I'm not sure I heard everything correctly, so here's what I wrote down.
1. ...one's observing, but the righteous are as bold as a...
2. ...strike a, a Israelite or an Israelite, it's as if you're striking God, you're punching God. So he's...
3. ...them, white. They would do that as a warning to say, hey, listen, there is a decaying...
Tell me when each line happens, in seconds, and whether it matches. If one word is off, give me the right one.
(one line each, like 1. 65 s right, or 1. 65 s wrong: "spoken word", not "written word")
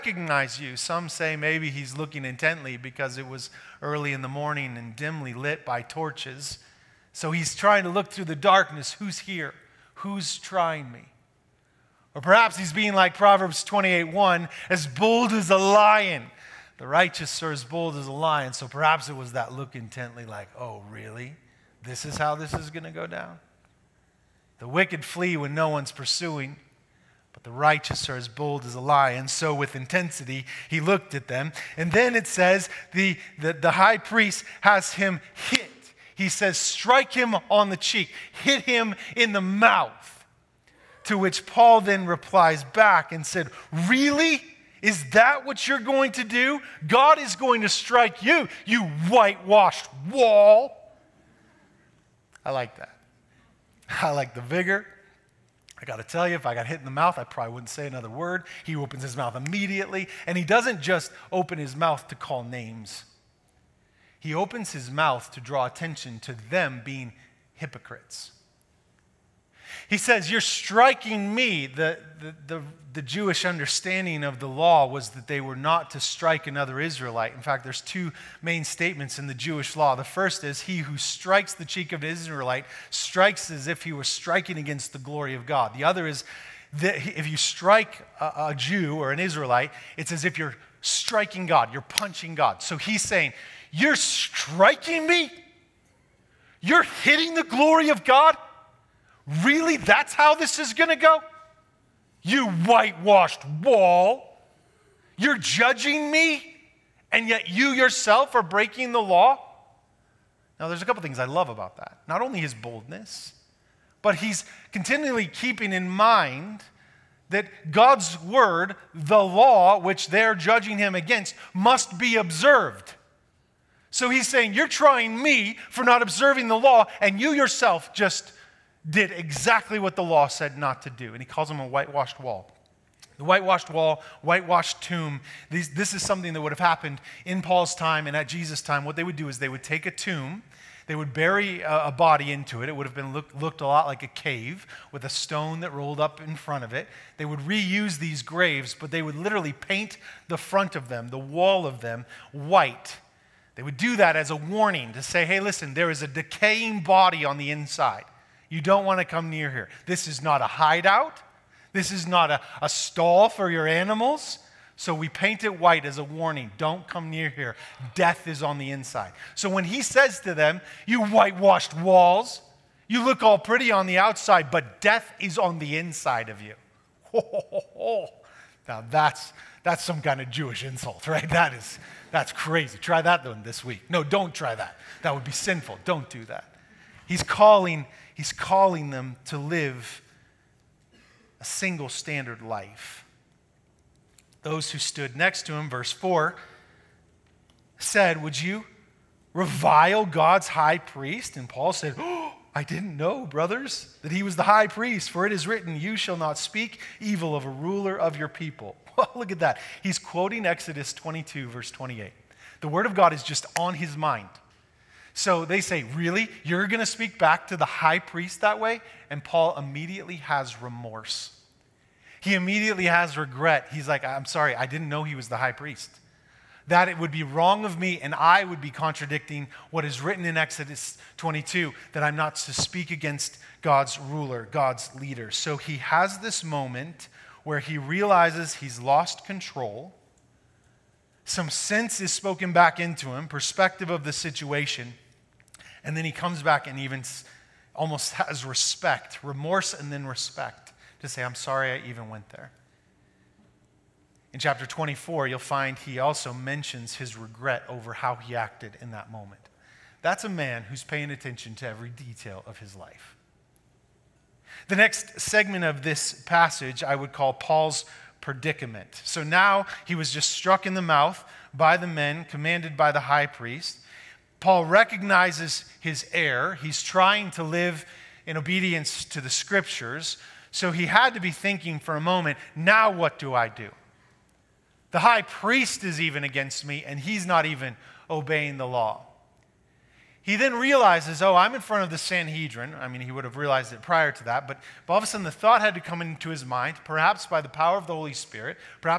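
1. 25 s wrong: "pursuing", not "observing"
2. 87 s wrong: "Jew", not "Israelite"
3. 151 s right.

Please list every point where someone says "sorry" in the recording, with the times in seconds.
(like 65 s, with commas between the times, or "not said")
224 s, 251 s.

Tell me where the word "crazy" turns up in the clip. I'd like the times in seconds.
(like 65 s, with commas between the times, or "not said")
182 s.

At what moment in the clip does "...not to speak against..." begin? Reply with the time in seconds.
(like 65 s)
232 s.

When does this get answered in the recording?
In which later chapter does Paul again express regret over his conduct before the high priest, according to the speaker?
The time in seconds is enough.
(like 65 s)
254 s.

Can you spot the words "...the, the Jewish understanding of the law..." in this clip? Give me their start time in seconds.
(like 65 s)
72 s.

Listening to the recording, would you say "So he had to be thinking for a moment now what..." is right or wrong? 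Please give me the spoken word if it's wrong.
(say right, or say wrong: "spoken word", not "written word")
right.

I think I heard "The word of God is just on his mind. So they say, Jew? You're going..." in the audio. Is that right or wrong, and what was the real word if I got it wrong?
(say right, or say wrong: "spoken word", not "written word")
wrong: "Really", not "Jew".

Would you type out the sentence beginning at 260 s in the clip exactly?
That's a man who's paying attention to every detail of his life.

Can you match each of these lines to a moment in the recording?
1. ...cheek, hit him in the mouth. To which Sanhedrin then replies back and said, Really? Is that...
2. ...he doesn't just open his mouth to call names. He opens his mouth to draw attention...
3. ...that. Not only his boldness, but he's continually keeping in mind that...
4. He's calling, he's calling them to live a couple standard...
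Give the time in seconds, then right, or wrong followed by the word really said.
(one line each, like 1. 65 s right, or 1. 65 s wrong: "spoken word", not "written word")
1. 37 s wrong: "Paul", not "Sanhedrin"
2. 60 s right
3. 111 s right
4. 187 s wrong: "single", not "couple".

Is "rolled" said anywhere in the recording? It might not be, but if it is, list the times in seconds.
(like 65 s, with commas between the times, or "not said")
145 s.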